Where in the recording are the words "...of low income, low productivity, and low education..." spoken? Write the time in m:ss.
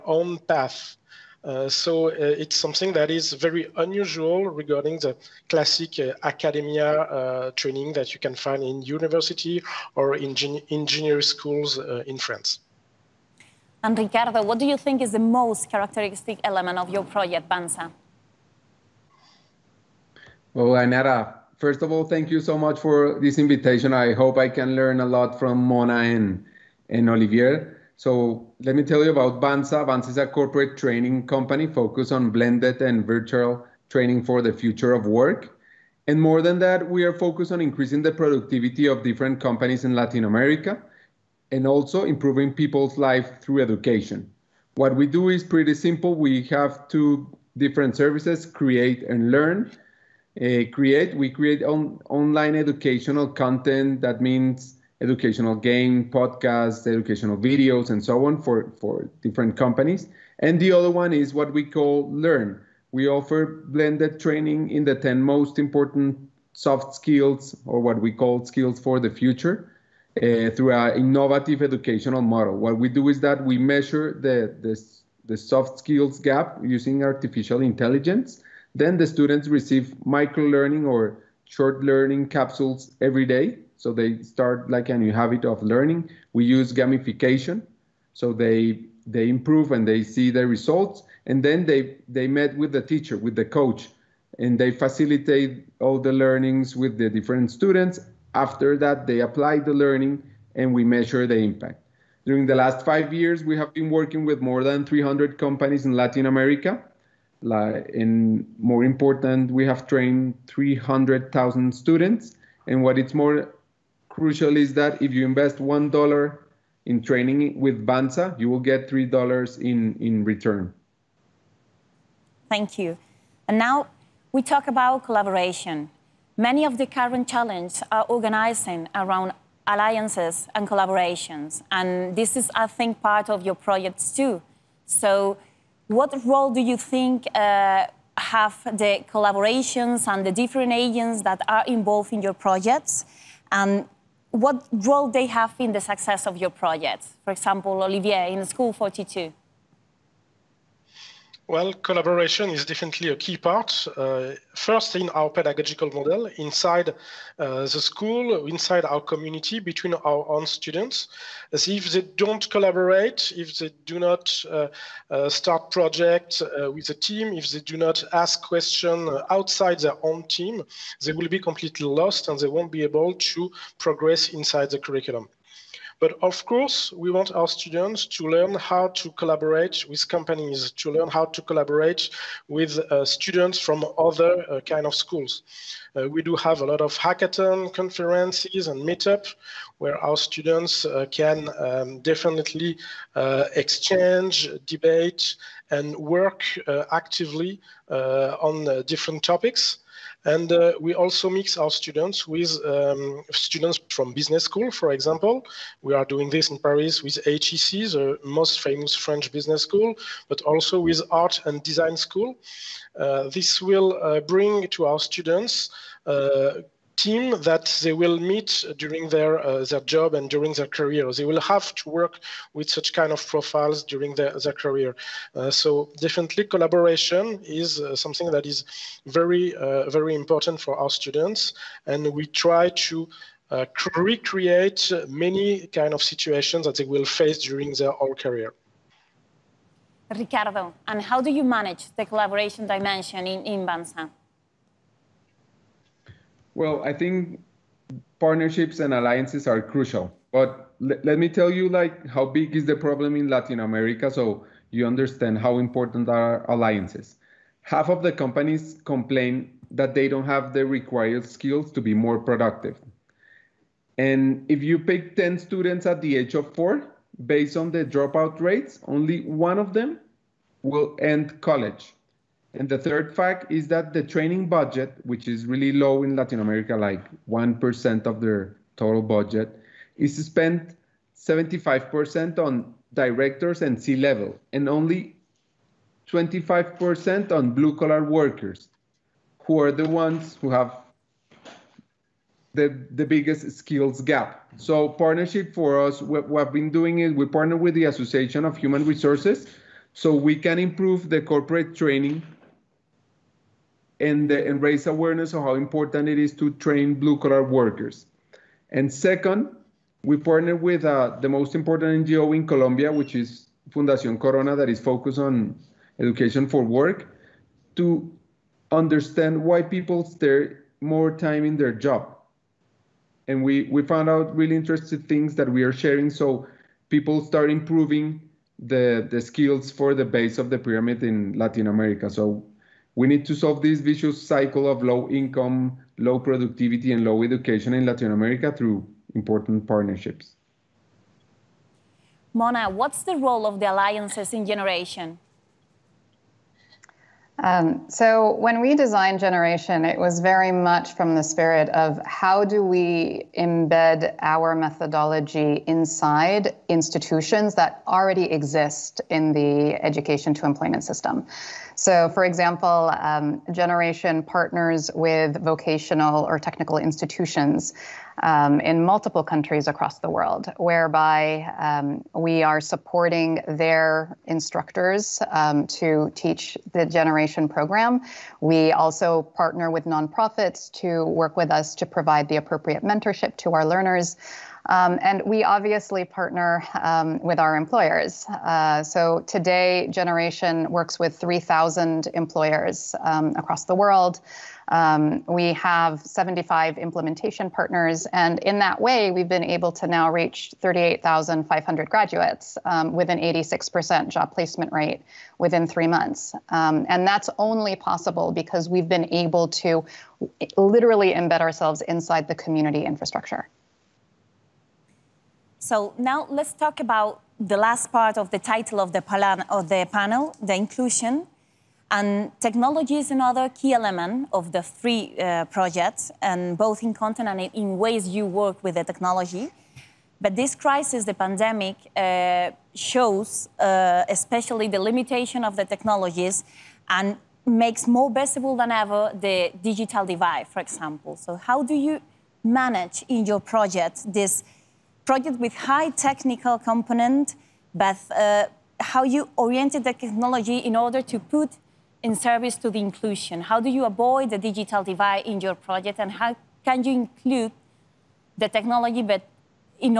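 5:34.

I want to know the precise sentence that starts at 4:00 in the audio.
Ricardo, and how do you manage the collaboration dimension in, in Banza?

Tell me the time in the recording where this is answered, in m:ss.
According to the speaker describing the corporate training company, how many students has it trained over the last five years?
1:50.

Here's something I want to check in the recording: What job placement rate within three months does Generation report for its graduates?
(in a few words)
86%.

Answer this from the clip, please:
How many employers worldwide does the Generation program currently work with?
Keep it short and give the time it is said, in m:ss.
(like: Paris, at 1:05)
3,000, at 6:31.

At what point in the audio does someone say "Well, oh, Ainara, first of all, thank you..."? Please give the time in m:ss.
0:20.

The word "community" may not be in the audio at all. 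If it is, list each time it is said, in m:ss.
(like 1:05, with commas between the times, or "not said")
2:38, 6:52.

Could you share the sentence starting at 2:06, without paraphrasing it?
Many of the current challenges are organizing around alliances and collaborations.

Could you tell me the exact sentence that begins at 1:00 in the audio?
And the other one is what we call Learn.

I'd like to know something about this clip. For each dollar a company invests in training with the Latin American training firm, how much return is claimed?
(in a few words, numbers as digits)
$3.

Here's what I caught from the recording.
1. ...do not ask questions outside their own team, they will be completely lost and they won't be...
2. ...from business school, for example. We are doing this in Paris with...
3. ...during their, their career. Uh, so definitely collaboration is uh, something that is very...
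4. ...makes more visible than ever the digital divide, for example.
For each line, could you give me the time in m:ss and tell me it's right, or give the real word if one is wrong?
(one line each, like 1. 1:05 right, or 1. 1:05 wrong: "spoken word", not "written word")
1. 2:47 right
2. 3:23 right
3. 3:43 right
4. 7:17 right.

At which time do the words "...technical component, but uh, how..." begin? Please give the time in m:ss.
7:25.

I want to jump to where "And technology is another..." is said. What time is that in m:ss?
7:01.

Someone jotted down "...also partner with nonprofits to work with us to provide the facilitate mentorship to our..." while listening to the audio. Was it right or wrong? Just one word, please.
wrong.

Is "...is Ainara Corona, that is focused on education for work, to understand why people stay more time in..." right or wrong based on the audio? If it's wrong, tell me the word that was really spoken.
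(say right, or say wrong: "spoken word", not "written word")
wrong: "Fundación", not "Ainara".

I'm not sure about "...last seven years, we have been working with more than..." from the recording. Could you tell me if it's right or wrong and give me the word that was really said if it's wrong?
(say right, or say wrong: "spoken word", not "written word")
wrong: "five", not "seven".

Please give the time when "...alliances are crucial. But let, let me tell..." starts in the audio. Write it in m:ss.
4:08.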